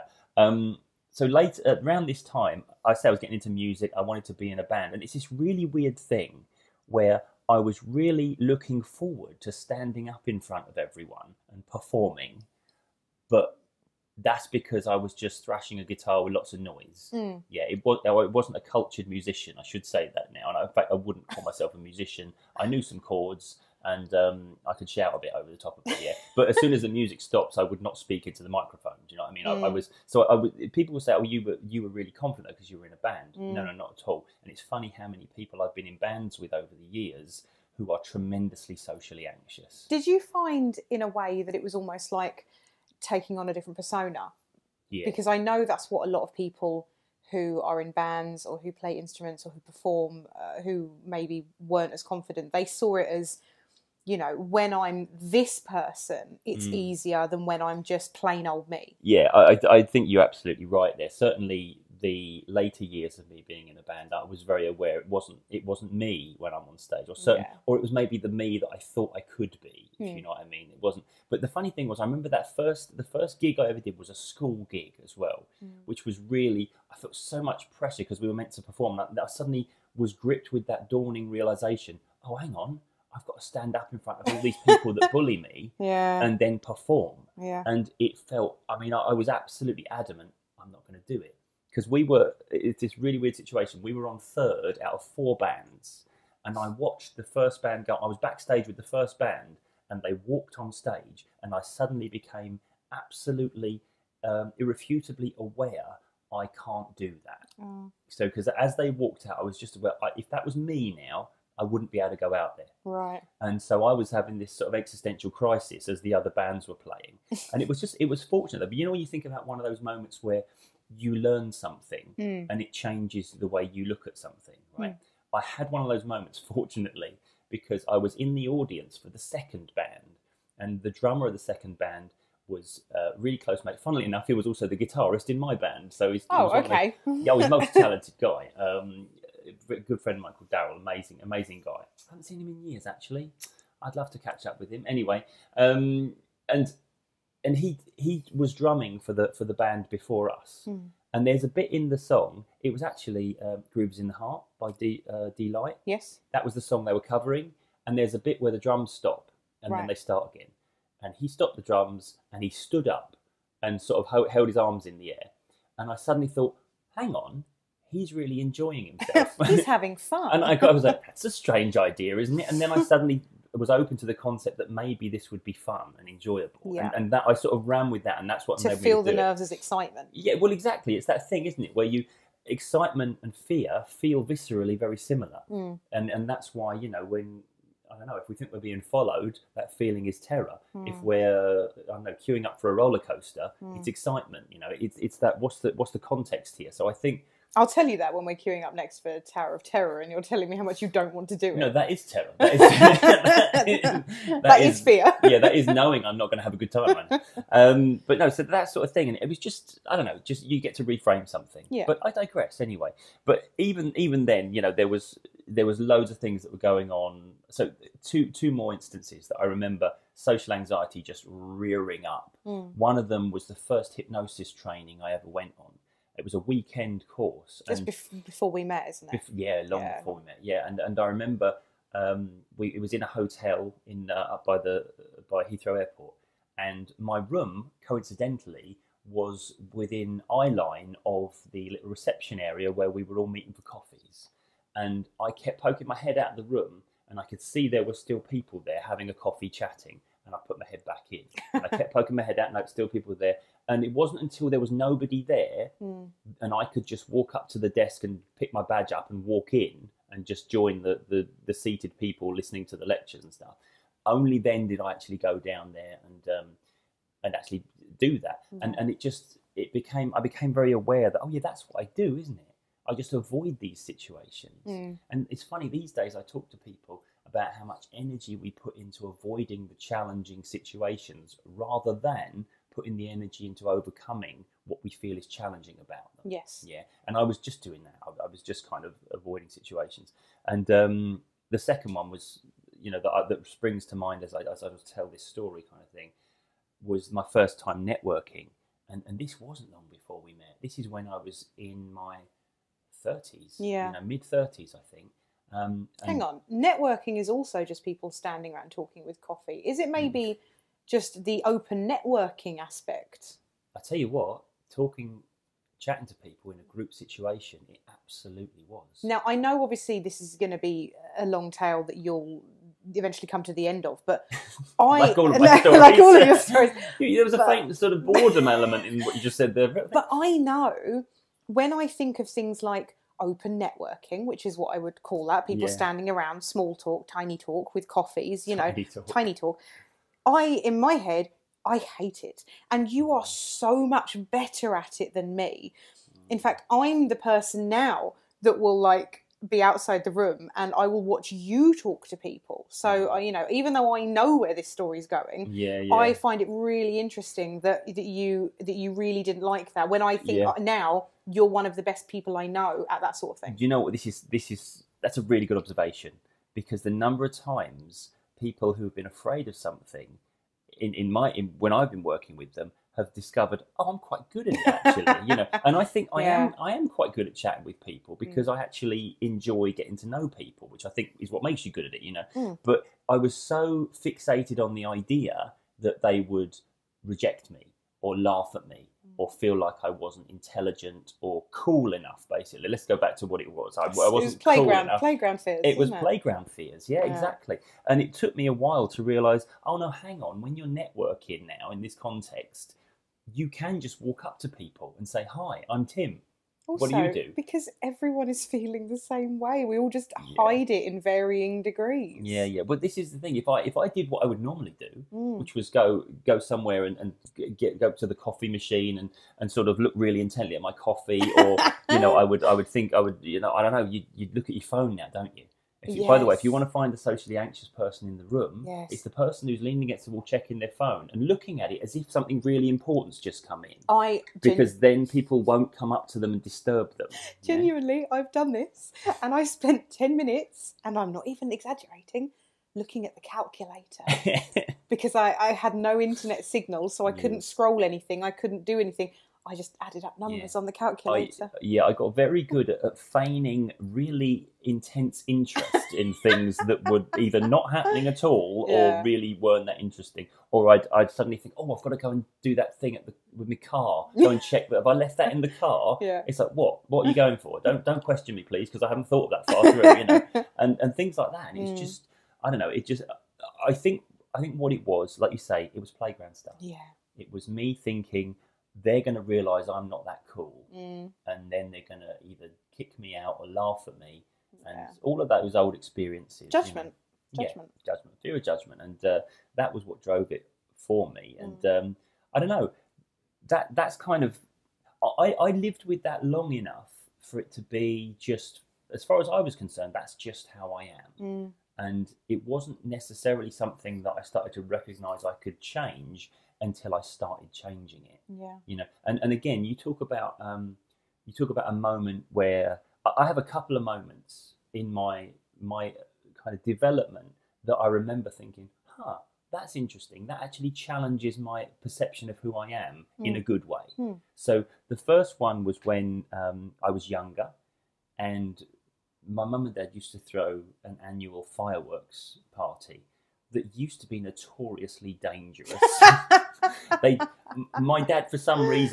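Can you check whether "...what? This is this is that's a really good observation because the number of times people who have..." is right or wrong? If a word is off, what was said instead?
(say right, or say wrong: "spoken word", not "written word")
right.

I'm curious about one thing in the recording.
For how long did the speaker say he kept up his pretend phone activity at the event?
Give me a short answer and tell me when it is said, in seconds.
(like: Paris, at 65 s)
10 minutes, at 439 s.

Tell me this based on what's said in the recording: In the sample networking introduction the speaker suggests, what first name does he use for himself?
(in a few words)
Tim.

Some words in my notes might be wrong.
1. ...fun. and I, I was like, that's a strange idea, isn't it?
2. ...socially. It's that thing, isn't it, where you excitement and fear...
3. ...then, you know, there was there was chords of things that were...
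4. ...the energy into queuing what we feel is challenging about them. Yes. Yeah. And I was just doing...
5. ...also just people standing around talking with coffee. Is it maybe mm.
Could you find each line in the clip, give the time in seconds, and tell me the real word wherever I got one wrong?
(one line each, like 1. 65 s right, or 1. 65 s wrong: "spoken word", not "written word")
1. 169 s right
2. 180 s wrong: "exactly", not "socially"
3. 214 s wrong: "loads", not "chords"
4. 282 s wrong: "overcoming", not "queuing"
5. 307 s right.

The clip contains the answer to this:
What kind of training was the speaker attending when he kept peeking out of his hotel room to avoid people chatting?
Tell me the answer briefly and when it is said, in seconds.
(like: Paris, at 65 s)
hypnosis training, at 223 s.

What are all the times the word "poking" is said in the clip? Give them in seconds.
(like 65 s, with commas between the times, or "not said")
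245 s, 251 s.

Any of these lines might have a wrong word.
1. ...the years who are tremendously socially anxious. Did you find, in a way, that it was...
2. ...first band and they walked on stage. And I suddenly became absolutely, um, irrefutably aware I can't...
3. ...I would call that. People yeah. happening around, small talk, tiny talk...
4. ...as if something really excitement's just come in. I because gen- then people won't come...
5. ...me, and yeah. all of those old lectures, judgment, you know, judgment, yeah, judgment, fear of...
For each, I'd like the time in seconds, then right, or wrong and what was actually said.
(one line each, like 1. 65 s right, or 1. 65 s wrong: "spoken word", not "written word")
1. 36 s right
2. 98 s right
3. 334 s wrong: "standing", not "happening"
4. 431 s wrong: "important", not "excitement"
5. 483 s wrong: "experiences", not "lectures".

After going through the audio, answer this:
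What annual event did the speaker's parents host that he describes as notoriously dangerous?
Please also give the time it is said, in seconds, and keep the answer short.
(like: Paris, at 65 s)
fireworks party, at 531 s.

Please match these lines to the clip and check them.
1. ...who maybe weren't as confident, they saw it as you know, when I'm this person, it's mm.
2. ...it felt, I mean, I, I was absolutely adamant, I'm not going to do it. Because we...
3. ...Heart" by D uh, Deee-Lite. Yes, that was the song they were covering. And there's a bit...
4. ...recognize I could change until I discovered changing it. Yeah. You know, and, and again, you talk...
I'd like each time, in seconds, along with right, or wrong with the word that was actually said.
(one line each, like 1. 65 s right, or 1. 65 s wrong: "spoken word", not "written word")
1. 50 s right
2. 87 s right
3. 154 s right
4. 504 s wrong: "started", not "discovered".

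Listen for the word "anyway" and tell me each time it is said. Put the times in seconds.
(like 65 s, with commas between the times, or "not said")
144 s, 212 s.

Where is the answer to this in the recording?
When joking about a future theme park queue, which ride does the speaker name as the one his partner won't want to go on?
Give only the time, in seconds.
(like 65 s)
199 s.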